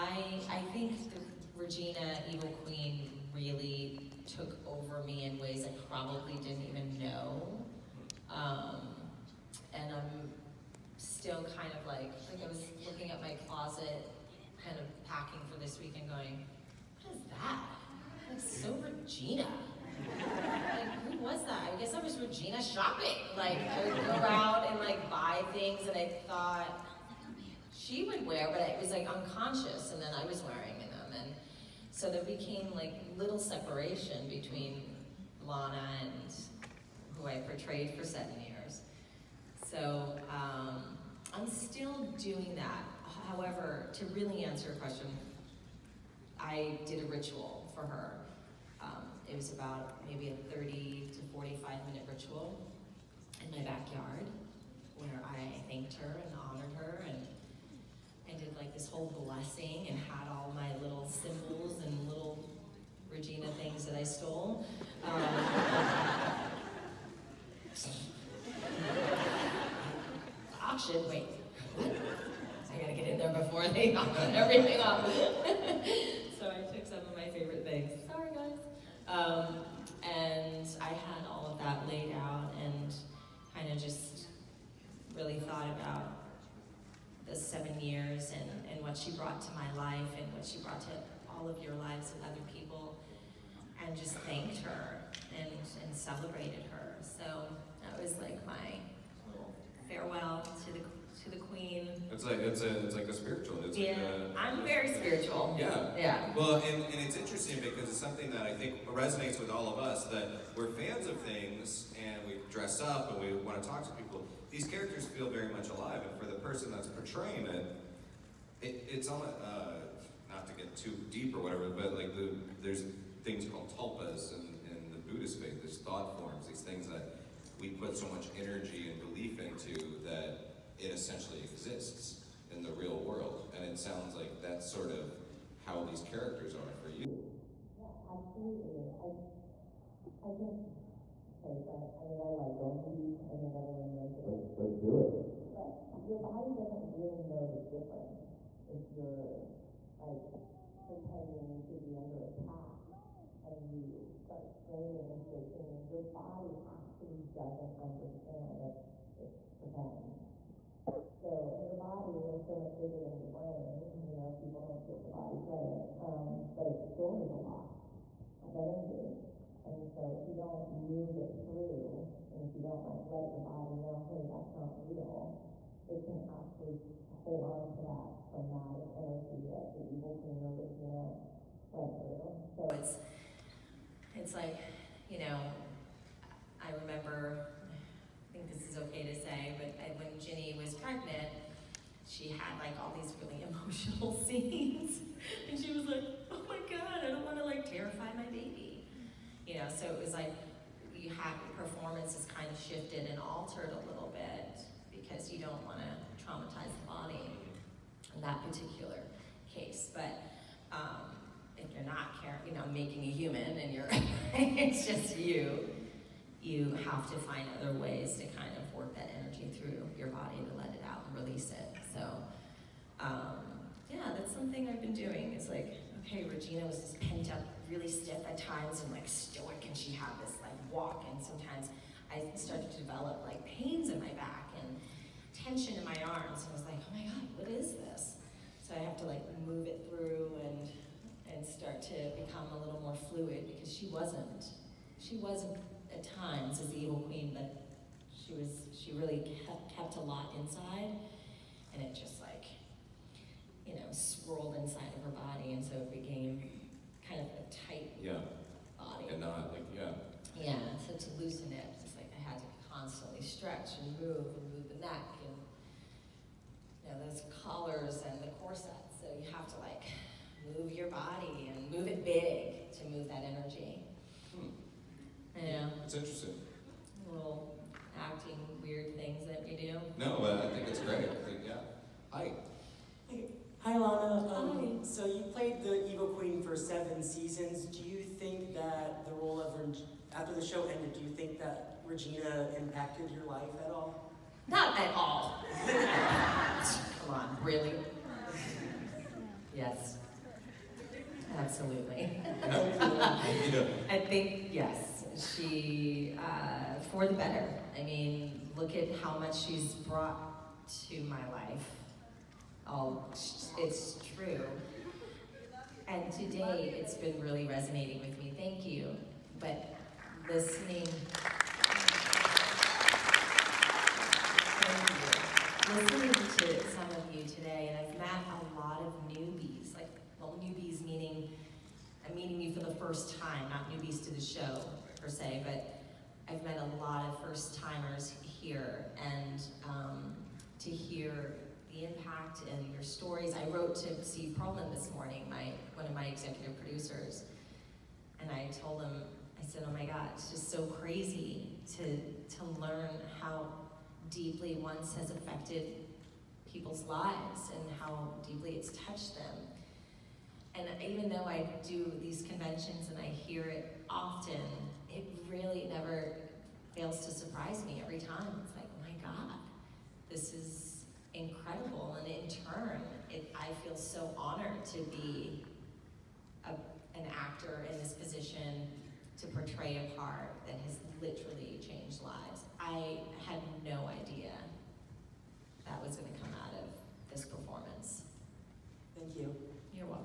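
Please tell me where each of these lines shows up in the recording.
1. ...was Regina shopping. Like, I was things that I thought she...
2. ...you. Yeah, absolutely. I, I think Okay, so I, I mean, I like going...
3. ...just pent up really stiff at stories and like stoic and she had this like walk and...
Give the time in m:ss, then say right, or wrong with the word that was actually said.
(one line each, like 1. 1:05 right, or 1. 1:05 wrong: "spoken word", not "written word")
1. 0:21 right
2. 2:16 right
3. 3:46 wrong: "times", not "stories".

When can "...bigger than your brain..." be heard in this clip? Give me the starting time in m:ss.
2:42.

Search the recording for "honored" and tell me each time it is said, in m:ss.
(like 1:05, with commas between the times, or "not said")
0:56, 6:14.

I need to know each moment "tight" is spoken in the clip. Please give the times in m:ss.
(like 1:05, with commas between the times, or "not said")
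4:17.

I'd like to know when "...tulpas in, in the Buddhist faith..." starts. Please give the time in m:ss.
2:03.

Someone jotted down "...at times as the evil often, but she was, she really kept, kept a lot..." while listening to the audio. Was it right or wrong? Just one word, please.
wrong.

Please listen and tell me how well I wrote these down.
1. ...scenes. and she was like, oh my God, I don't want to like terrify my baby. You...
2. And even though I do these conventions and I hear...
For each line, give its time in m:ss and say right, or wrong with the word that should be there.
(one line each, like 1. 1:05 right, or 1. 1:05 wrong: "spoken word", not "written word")
1. 3:14 right
2. 6:00 right.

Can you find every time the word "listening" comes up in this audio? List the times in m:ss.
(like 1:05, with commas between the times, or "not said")
5:20, 5:25.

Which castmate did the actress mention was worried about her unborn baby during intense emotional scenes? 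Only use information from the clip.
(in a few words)
Ginny.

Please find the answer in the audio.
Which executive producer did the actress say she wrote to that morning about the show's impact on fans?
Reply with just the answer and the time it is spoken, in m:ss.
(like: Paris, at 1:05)
Steve Pearlman, at 5:44.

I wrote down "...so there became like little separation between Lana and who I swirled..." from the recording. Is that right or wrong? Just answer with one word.
wrong.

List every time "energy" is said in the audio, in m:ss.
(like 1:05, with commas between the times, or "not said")
2:08, 2:48, 2:58, 3:39, 4:33.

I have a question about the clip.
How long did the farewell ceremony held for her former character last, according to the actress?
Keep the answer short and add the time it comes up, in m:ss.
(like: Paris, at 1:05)
30 to 45 minutes, at 0:50.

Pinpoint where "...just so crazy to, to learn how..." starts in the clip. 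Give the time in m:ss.
5:50.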